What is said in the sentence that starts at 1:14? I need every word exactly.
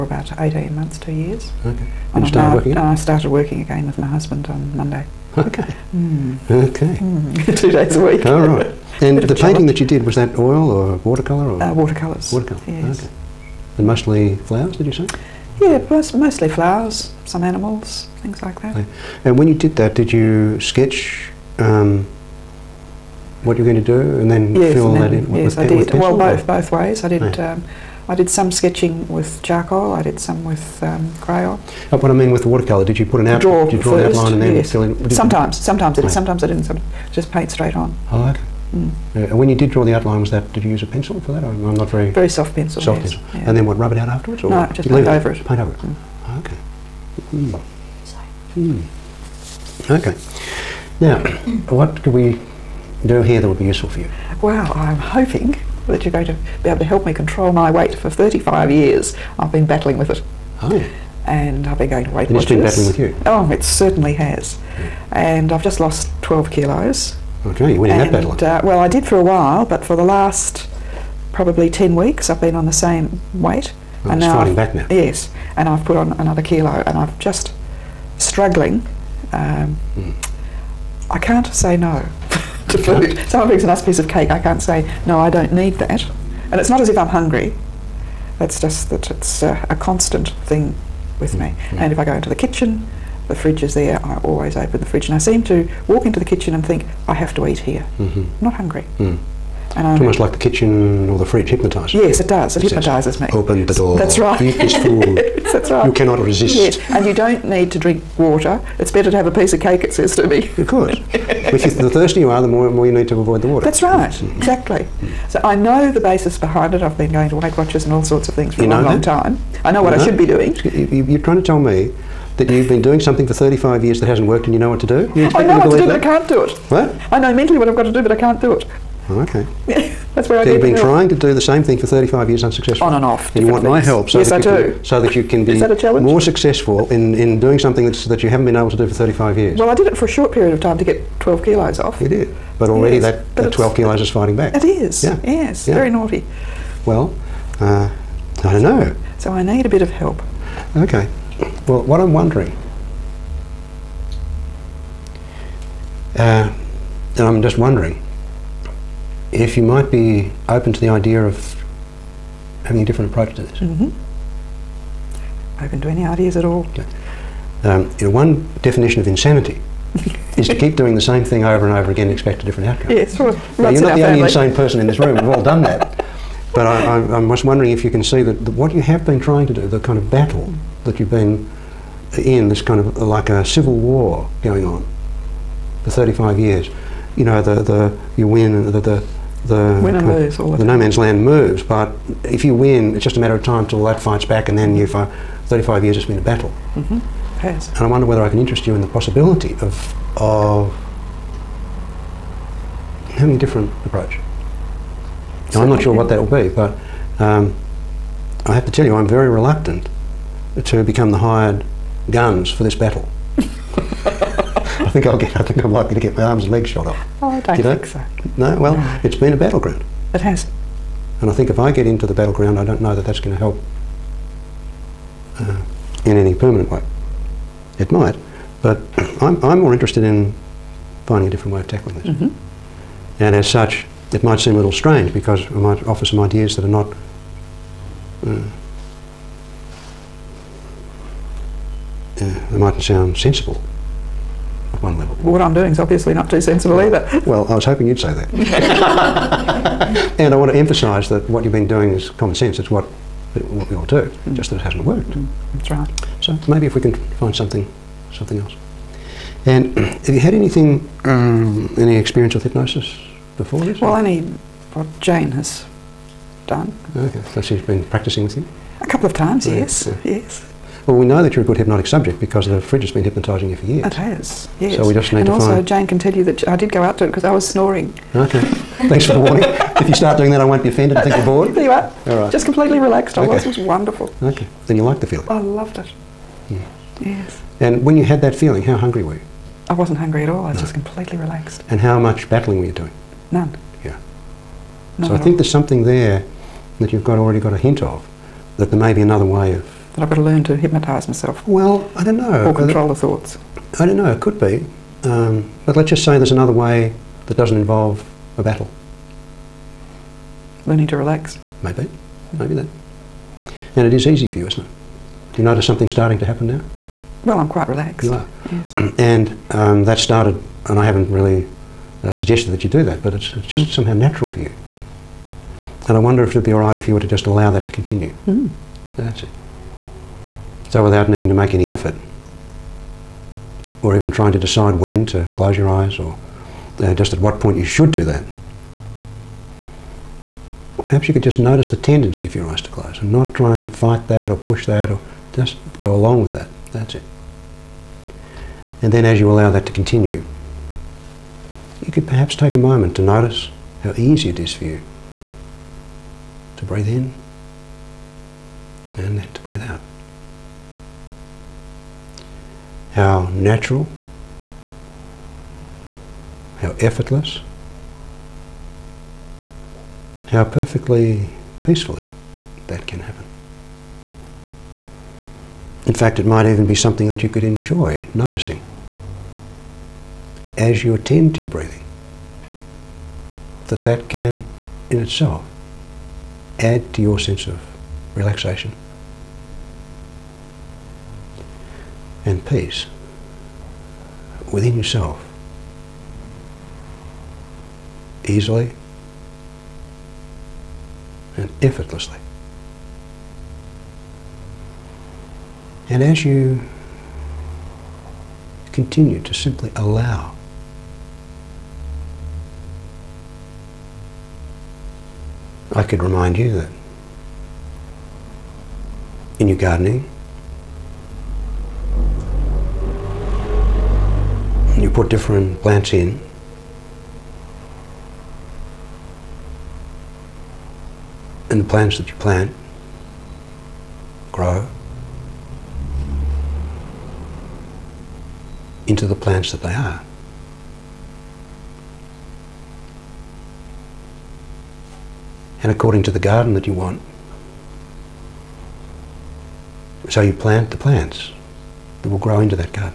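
and now fighting I've, back now.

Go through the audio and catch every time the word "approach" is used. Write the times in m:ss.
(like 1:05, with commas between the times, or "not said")
2:43, 3:23.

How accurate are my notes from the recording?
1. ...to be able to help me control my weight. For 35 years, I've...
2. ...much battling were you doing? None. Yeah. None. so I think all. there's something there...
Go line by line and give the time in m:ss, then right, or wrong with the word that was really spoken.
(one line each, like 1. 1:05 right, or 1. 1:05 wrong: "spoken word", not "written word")
1. 0:56 right
2. 4:51 right.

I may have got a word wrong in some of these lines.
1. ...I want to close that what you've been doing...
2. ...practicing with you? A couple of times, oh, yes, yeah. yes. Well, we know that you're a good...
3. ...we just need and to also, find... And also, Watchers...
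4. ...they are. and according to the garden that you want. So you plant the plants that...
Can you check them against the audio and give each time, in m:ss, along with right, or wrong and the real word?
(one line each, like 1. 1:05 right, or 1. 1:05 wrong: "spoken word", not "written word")
1. 4:10 wrong: "emphasise", not "close"
2. 4:27 right
3. 4:34 wrong: "Jane", not "Watchers"
4. 7:19 right.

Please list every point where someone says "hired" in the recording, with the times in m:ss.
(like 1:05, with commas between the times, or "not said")
3:31.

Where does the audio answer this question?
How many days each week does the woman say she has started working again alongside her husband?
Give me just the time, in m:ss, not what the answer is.
0:07.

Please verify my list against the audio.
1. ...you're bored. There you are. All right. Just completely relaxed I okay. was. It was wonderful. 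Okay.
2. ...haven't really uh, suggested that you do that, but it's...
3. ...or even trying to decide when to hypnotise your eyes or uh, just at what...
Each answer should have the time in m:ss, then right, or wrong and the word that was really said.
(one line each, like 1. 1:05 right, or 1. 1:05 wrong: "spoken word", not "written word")
1. 4:41 right
2. 5:20 right
3. 5:33 wrong: "close", not "hypnotise".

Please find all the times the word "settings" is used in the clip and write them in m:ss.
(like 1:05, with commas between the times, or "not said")
not said.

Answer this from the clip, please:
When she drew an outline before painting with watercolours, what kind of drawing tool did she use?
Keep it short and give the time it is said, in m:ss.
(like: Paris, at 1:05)
very soft pencil, at 0:42.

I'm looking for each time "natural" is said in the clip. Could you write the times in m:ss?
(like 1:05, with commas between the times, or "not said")
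5:23, 6:03.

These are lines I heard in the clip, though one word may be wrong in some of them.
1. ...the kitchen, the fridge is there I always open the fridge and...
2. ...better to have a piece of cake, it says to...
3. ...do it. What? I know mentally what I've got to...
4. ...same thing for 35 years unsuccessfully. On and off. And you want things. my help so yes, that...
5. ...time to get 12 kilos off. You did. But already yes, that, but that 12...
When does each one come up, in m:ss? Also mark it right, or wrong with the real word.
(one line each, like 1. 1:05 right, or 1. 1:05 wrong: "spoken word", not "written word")
1. 1:32 right
2. 1:48 right
3. 2:06 right
4. 2:11 right
5. 2:20 right.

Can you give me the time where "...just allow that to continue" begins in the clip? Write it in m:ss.
5:27.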